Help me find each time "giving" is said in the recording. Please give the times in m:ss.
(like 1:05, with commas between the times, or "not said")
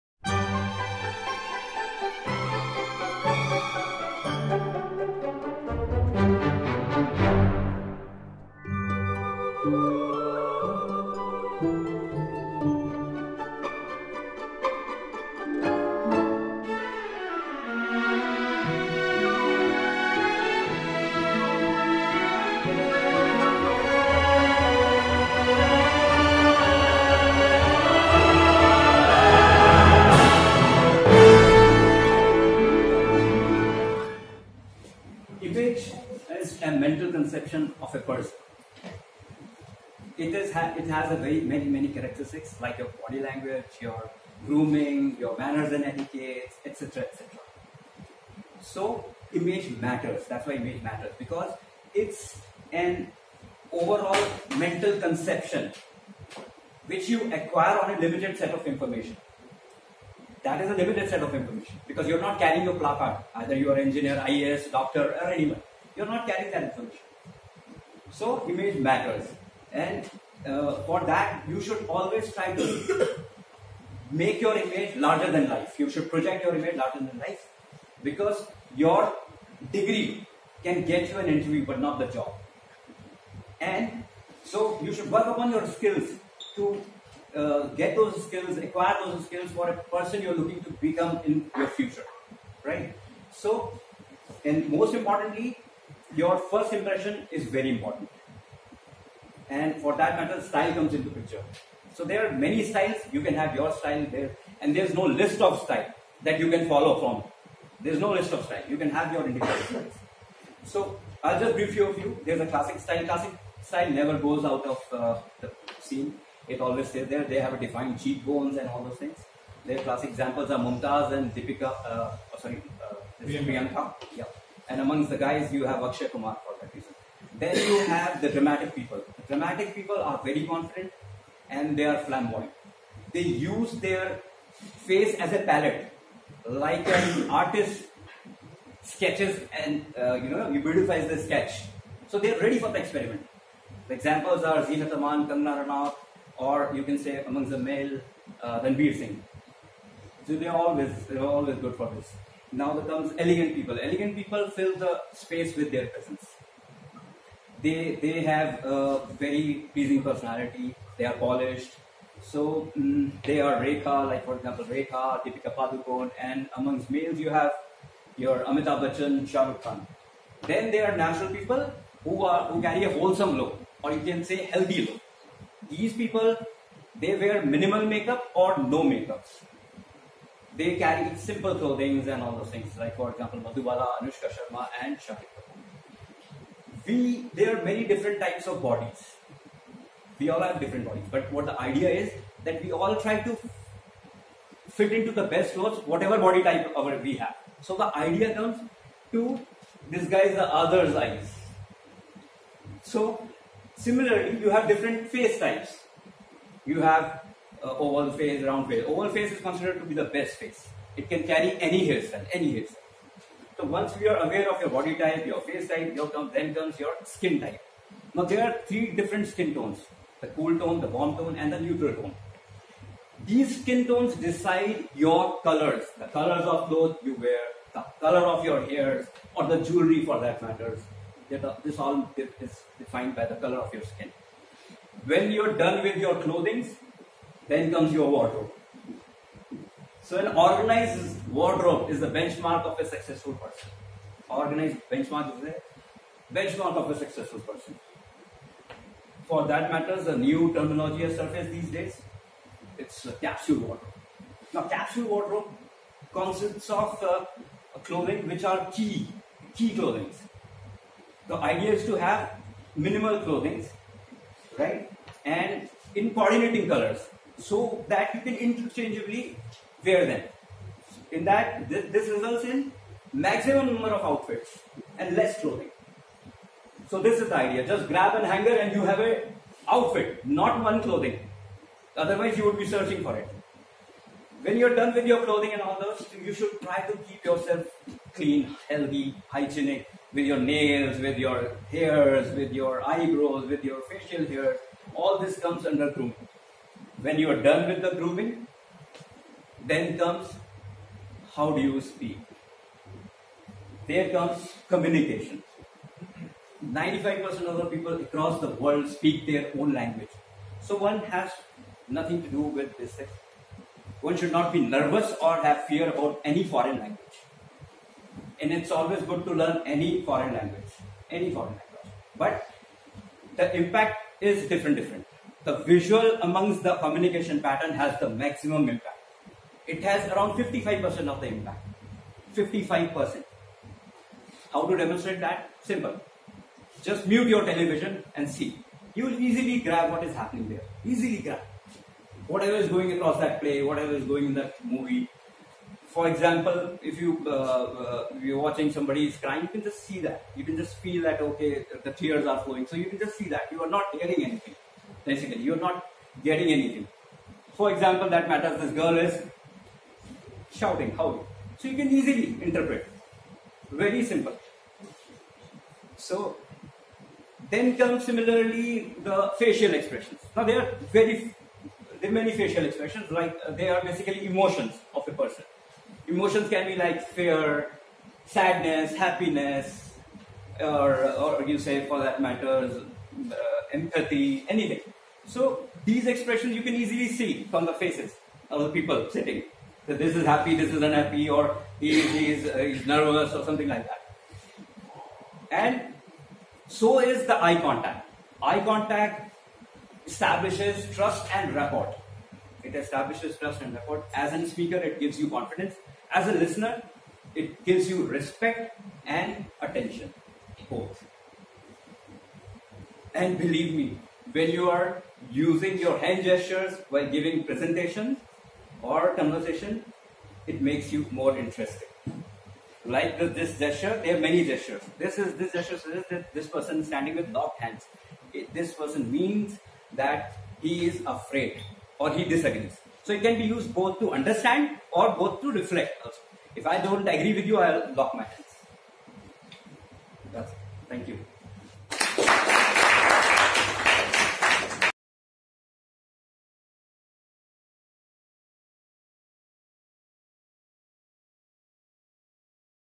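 6:57.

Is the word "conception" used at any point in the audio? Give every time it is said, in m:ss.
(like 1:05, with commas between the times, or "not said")
0:55.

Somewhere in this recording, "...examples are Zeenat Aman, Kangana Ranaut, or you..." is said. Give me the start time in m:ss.
2:23.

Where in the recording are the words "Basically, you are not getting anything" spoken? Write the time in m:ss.
5:55.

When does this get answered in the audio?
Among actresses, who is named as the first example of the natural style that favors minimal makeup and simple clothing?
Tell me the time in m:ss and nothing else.
3:03.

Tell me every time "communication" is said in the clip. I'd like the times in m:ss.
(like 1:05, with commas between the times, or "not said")
5:04, 5:26.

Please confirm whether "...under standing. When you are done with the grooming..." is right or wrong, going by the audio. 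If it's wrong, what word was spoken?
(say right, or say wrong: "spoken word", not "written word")
wrong: "grooming", not "standing".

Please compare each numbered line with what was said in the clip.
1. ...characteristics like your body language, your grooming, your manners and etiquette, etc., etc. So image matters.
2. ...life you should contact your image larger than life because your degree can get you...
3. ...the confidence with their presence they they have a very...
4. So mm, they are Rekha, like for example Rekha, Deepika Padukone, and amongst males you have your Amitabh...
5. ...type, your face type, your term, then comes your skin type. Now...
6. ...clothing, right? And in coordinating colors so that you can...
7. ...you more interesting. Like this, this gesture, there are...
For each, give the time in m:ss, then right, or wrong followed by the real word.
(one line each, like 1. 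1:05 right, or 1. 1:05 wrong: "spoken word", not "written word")
1. 0:41 right
2. 1:15 wrong: "project", not "contact"
3. 2:34 wrong: "space", not "confidence"
4. 2:42 right
5. 3:34 right
6. 4:23 right
7. 7:00 right.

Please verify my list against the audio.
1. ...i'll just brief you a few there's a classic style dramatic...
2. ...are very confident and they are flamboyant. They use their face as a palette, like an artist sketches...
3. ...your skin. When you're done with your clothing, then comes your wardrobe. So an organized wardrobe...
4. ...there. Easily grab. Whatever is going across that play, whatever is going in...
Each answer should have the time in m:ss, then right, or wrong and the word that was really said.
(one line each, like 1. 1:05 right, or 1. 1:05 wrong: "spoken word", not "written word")
1. 1:51 wrong: "classic", not "dramatic"
2. 2:09 right
3. 3:53 right
4. 5:40 right.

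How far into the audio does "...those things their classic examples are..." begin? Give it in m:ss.
1:58.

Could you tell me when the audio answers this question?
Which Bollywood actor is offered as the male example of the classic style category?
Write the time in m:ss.
2:05.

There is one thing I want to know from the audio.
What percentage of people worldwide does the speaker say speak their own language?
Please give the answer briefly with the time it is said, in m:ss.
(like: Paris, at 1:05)
95%, at 5:06.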